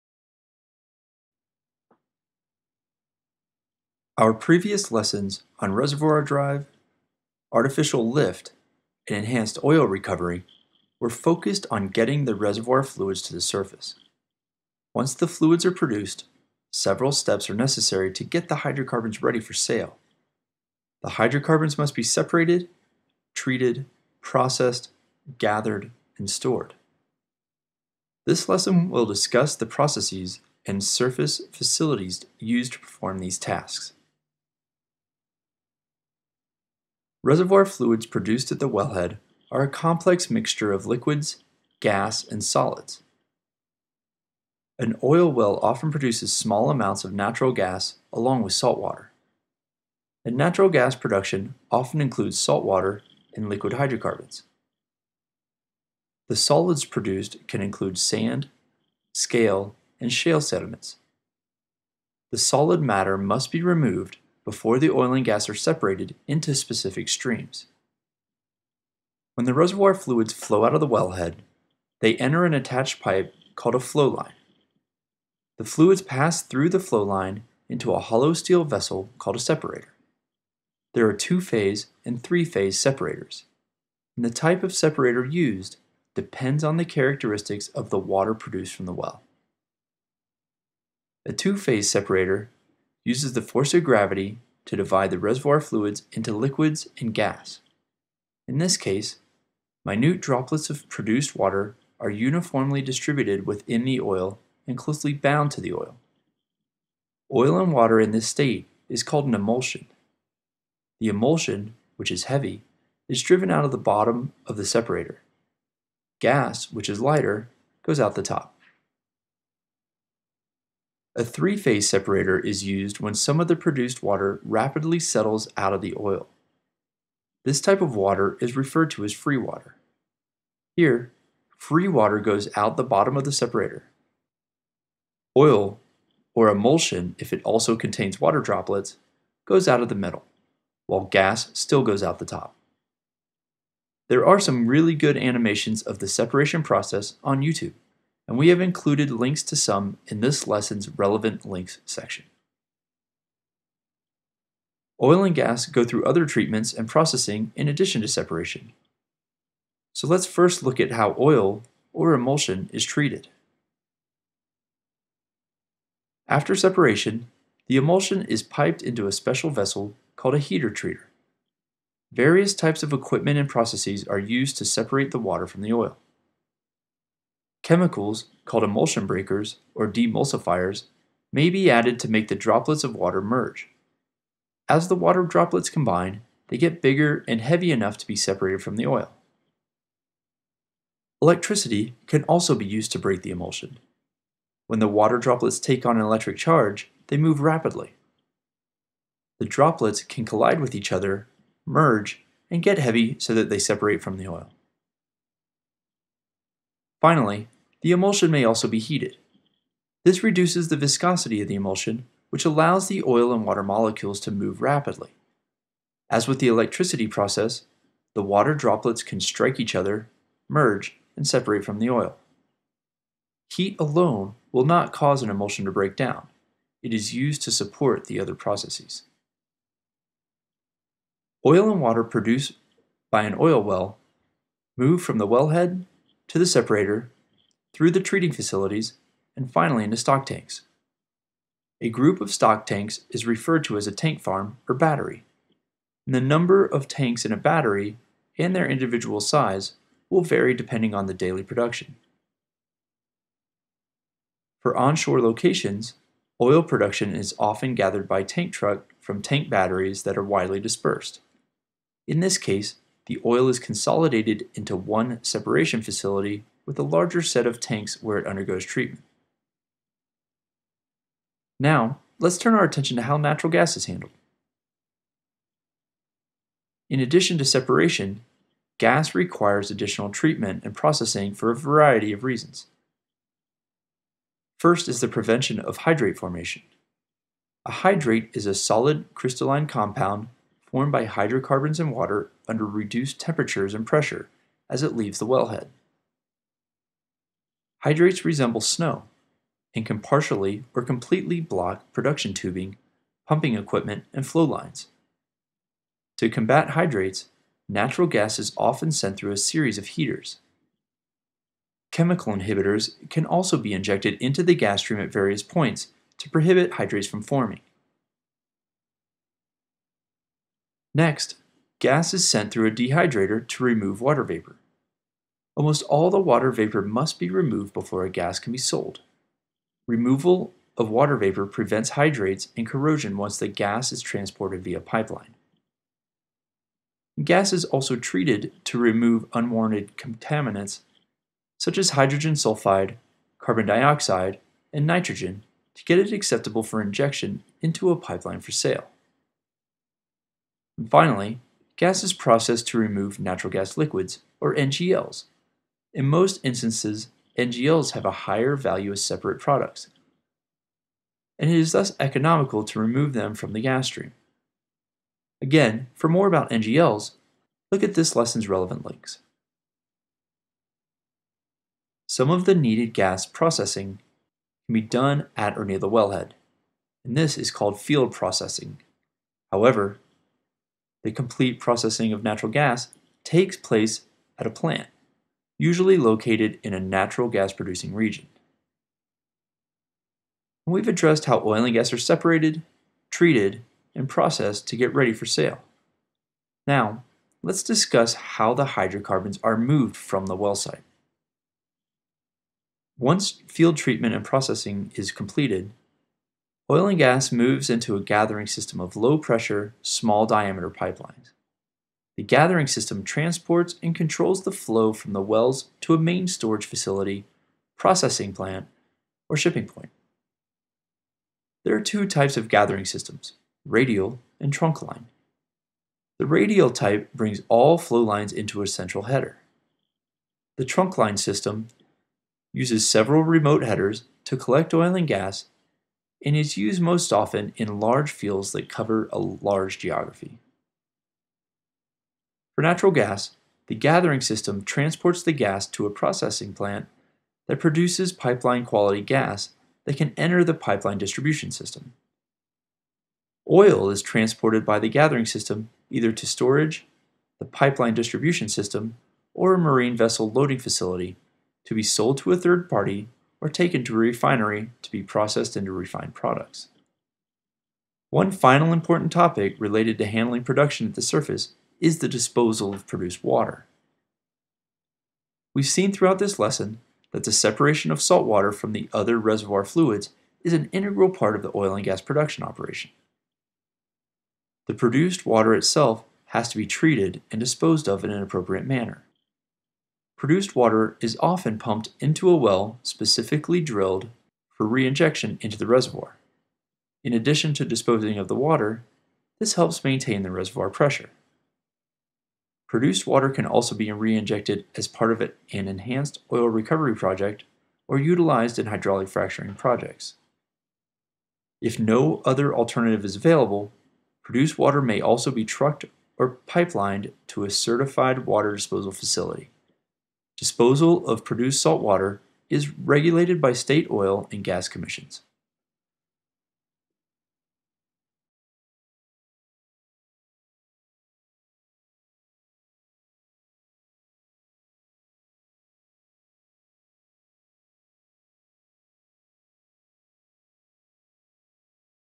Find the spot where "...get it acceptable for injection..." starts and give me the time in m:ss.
5:45.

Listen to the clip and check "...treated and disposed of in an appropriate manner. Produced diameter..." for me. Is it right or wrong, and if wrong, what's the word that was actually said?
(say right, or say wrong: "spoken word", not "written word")
wrong: "water", not "diameter".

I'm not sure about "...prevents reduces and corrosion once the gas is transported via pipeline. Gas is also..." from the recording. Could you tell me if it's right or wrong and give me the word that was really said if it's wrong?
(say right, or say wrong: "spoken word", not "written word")
wrong: "hydrates", not "reduces".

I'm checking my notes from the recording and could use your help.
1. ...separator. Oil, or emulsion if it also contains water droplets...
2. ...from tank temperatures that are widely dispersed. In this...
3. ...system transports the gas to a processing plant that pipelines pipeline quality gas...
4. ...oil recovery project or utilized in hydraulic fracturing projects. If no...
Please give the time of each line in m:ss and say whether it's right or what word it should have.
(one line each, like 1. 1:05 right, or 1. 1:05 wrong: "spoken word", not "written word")
1. 2:13 right
2. 4:19 wrong: "batteries", not "temperatures"
3. 7:24 wrong: "produces", not "pipelines"
4. 8:26 right.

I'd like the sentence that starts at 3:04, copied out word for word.
As the water droplets combine, they get bigger and heavy enough to be separated from the oil.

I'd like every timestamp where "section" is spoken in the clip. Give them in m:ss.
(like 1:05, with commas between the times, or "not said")
2:31.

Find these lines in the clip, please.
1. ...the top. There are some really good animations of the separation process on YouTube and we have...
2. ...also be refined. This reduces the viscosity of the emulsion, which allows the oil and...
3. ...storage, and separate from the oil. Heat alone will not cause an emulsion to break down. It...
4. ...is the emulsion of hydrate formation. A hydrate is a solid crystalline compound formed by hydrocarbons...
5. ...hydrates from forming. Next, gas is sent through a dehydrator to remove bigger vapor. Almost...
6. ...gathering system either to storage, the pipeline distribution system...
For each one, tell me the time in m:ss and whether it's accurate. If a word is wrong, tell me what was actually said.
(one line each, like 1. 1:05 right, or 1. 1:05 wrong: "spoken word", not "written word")
1. 2:22 right
2. 3:28 wrong: "heated", not "refined"
3. 3:40 wrong: "merge", not "storage"
4. 4:44 wrong: "prevention", not "emulsion"
5. 5:16 wrong: "water", not "bigger"
6. 7:34 right.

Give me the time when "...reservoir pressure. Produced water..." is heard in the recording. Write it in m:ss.
8:20.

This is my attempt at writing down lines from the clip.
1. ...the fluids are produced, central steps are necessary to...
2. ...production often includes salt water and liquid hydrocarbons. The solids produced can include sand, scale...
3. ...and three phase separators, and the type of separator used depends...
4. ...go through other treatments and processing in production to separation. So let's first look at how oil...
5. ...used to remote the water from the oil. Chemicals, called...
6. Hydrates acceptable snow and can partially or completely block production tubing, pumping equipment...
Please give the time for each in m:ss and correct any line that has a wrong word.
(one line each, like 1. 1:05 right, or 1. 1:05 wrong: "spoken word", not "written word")
1. 0:15 wrong: "several", not "central"
2. 0:50 right
3. 1:22 right
4. 2:35 wrong: "addition", not "production"
5. 2:54 wrong: "separate", not "remote"
6. 4:57 wrong: "resemble", not "acceptable".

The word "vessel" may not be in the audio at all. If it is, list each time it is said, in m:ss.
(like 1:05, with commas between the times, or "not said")
1:18, 2:49, 7:39.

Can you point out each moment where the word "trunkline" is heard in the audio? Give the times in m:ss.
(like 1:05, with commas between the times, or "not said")
7:04, 7:10.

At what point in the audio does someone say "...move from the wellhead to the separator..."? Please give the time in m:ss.
3:54.